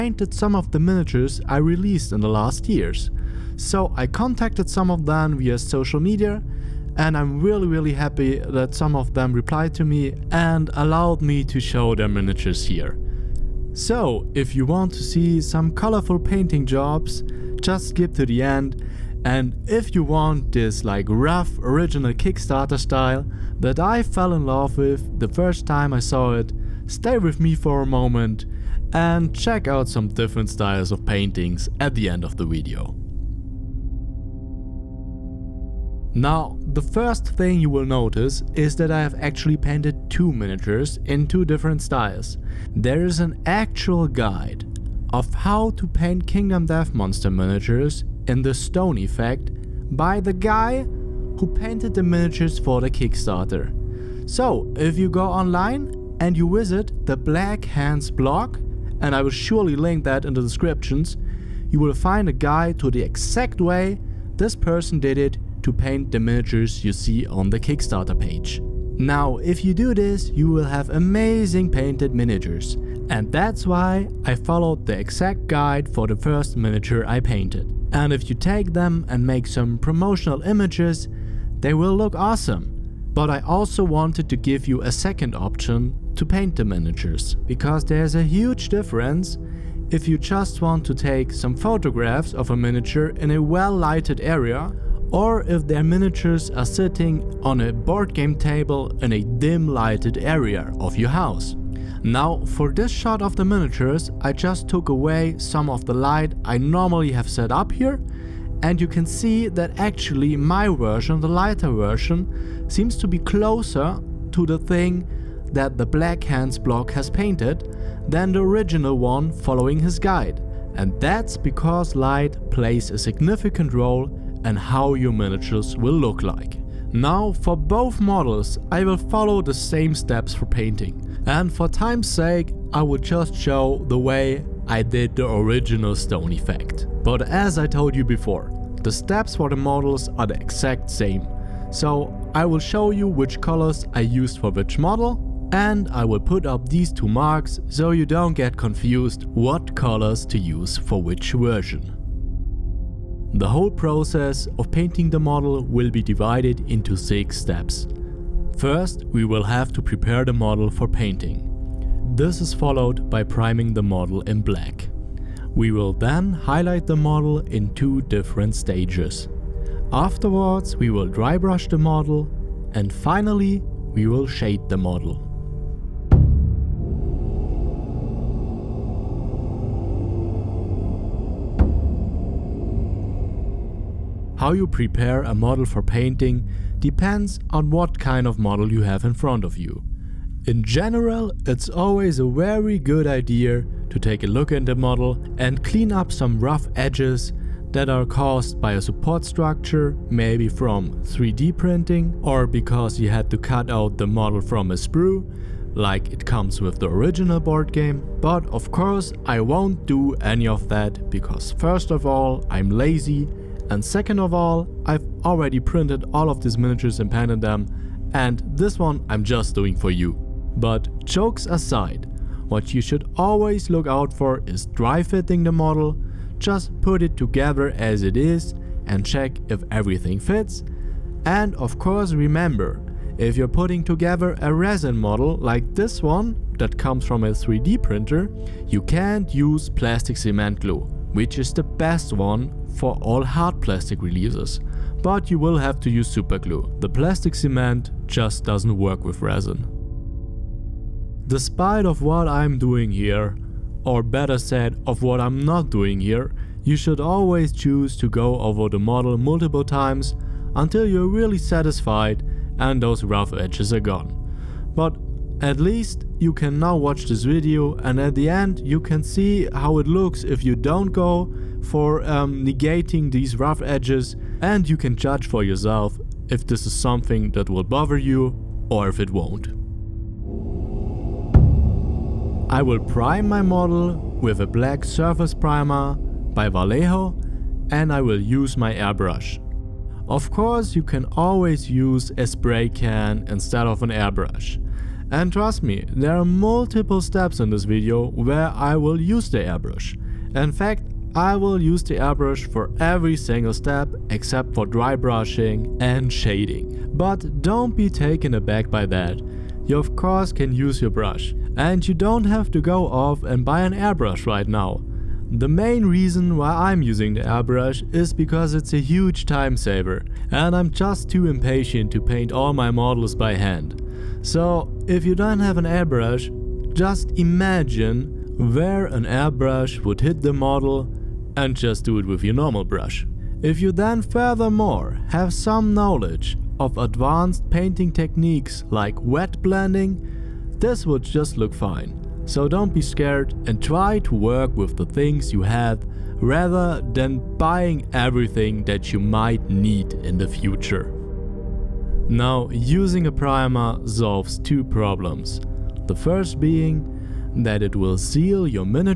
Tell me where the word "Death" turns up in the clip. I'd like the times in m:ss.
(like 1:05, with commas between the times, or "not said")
0:46.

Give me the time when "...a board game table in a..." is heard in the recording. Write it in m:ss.
1:37.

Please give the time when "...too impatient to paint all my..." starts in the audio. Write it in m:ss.
5:21.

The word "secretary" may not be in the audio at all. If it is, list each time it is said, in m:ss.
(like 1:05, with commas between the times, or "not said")
not said.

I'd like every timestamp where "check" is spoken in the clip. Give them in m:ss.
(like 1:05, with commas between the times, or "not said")
0:29, 3:49.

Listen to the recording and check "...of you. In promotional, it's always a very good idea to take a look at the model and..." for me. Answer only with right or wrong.
wrong.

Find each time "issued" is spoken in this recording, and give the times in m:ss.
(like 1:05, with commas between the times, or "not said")
not said.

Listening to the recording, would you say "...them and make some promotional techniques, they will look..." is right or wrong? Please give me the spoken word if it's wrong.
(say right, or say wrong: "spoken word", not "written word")
wrong: "images", not "techniques".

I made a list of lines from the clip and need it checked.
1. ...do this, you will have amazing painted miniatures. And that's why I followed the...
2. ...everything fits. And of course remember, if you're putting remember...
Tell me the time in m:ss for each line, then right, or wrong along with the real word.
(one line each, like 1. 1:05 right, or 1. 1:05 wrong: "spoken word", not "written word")
1. 1:09 right
2. 3:49 wrong: "together", not "remember".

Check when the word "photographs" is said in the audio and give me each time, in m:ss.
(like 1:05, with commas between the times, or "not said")
1:31.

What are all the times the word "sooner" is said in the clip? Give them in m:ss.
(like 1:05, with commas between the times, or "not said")
not said.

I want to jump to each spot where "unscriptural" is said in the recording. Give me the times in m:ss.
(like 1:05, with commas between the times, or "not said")
not said.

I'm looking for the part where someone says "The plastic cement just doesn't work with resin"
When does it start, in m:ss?
4:06.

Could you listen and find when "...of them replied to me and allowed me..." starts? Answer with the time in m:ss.
0:08.